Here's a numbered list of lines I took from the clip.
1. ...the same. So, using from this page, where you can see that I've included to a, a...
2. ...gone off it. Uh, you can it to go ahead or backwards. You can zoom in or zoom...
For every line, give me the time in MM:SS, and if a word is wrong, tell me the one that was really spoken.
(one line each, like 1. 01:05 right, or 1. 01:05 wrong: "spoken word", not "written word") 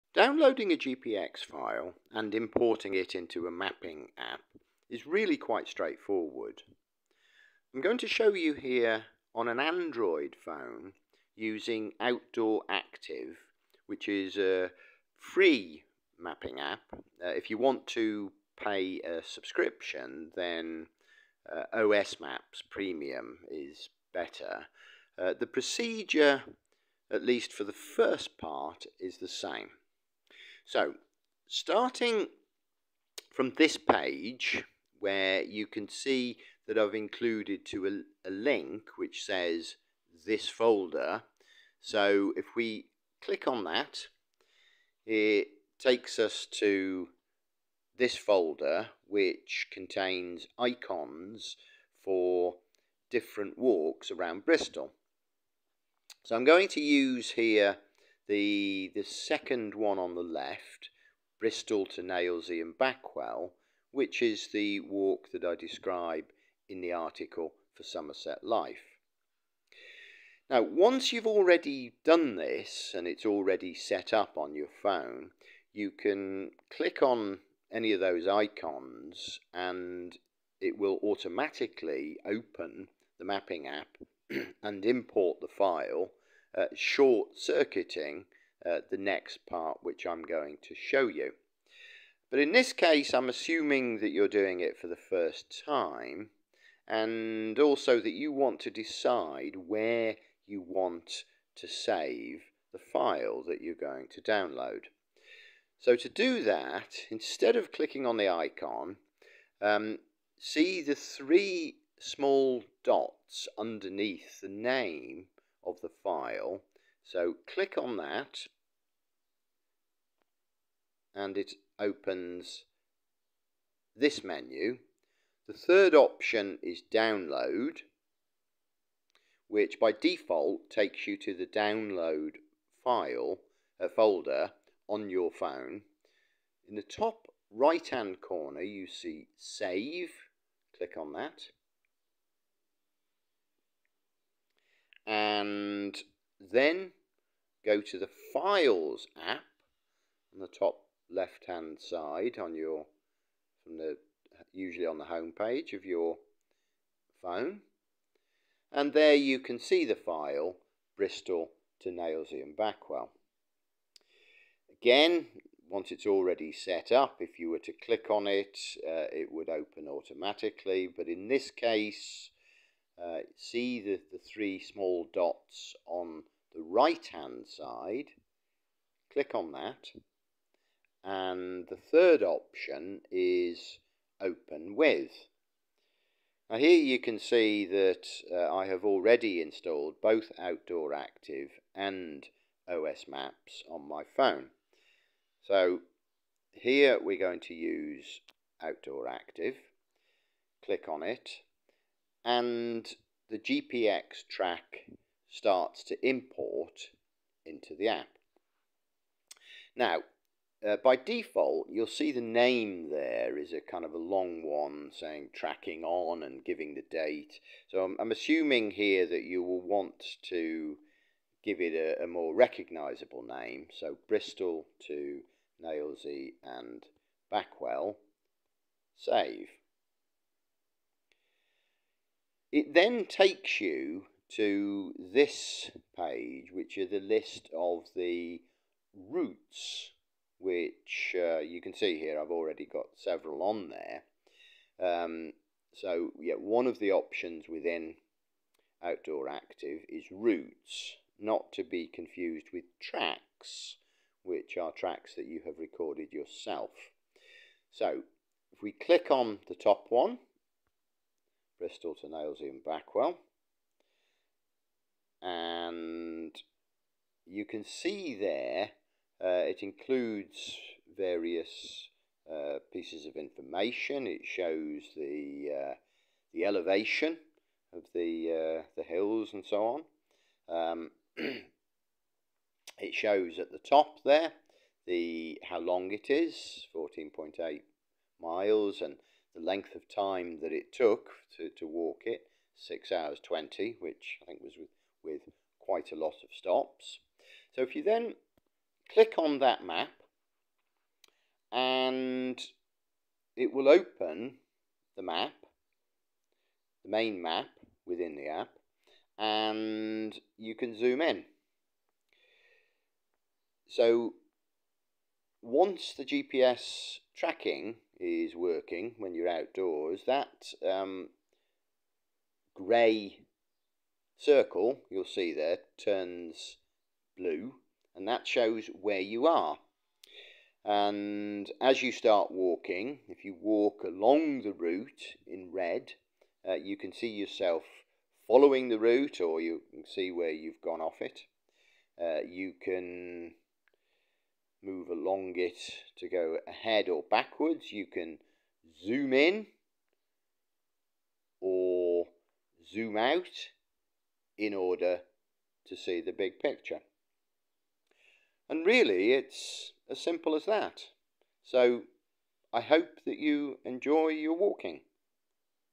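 1. 00:29 wrong: "starting", not "using"
2. 05:40 right.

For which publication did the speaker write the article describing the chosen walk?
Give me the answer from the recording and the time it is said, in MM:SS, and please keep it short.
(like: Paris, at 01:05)
Somerset Life, at 01:07.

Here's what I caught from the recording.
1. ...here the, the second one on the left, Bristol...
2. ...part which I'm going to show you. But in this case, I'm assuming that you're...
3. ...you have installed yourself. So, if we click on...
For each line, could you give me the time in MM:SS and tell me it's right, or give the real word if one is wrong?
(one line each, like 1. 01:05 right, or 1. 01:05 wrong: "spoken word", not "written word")
1. 00:57 right
2. 01:29 right
3. 04:15 wrong: "recorded", not "installed".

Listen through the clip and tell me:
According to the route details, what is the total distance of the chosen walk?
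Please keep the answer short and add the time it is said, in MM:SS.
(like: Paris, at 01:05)
14.8 miles, at 04:46.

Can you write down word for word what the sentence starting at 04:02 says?
I've already got several on there.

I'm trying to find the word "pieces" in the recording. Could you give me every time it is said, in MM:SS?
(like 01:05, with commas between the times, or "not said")
04:32.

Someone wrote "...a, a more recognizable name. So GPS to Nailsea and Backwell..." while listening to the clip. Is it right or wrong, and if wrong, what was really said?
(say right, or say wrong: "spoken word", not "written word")
wrong: "Bristol", not "GPS".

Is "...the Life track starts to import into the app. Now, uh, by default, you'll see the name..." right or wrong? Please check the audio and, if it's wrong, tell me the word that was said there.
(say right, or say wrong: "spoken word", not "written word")
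wrong: "GPX", not "Life".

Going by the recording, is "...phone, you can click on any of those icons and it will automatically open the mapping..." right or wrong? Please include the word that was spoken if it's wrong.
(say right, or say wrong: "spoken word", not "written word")
right.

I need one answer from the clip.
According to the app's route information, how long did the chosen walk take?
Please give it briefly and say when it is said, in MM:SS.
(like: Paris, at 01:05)
6 hours 20, at 04:52.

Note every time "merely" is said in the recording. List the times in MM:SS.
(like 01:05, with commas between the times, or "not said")
not said.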